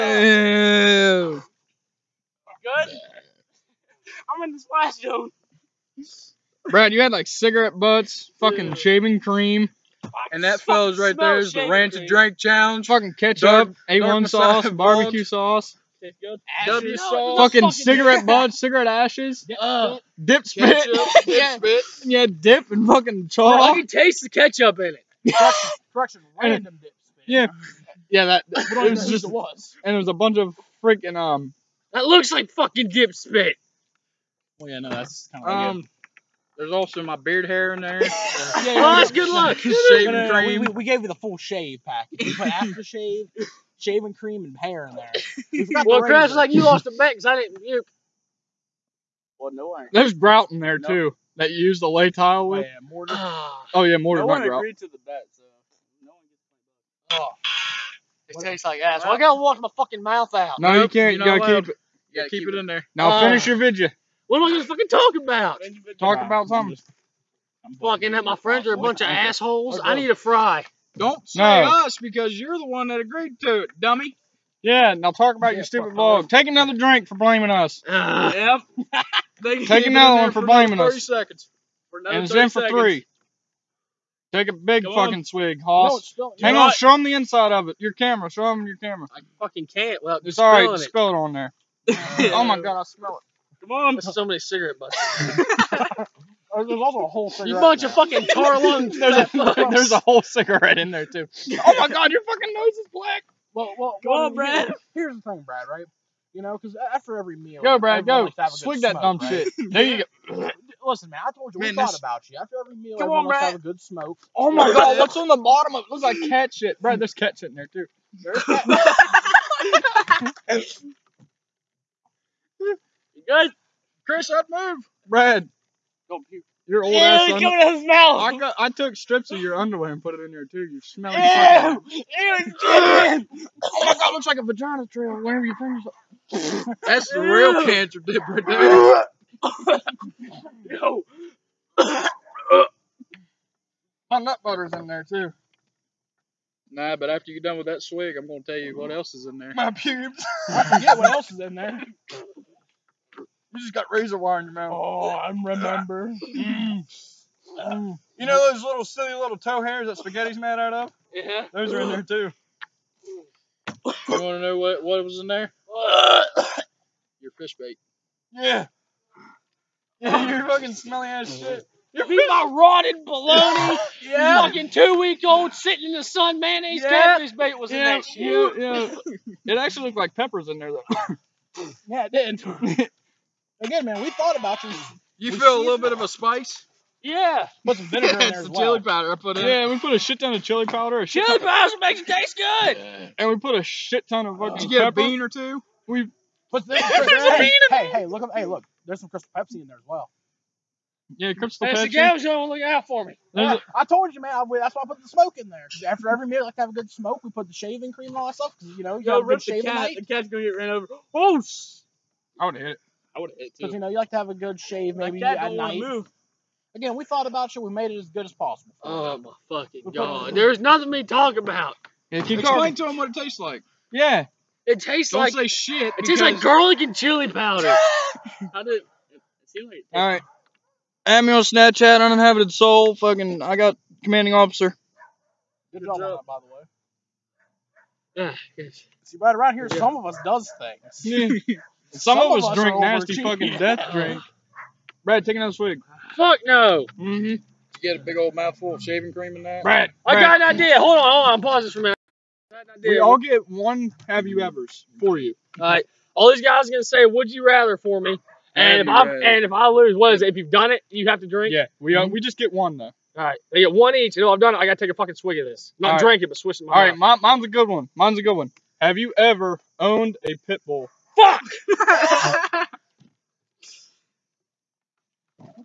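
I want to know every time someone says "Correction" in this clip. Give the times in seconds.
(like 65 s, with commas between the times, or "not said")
25 s.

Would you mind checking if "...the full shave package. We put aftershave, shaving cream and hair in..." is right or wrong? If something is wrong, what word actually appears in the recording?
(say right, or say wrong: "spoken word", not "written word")
right.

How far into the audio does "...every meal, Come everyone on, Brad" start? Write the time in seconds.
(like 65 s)
112 s.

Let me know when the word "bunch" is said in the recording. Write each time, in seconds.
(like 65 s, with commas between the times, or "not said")
30 s, 68 s, 97 s.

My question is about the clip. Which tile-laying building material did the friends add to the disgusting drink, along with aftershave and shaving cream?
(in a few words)
mortar.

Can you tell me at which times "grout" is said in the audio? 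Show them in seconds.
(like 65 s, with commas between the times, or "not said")
50 s, 54 s.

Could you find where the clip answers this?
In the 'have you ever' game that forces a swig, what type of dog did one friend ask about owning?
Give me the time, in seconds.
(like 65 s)
270 s.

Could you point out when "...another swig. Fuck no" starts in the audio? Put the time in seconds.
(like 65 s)
245 s.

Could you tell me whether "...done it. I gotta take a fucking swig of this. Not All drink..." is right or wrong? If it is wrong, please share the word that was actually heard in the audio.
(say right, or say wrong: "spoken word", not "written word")
right.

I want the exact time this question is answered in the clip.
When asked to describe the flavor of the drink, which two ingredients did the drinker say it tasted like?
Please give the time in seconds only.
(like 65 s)
226 s.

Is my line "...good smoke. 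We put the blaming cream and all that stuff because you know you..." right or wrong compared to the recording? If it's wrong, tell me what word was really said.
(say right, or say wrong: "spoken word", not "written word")
wrong: "shaving", not "blaming".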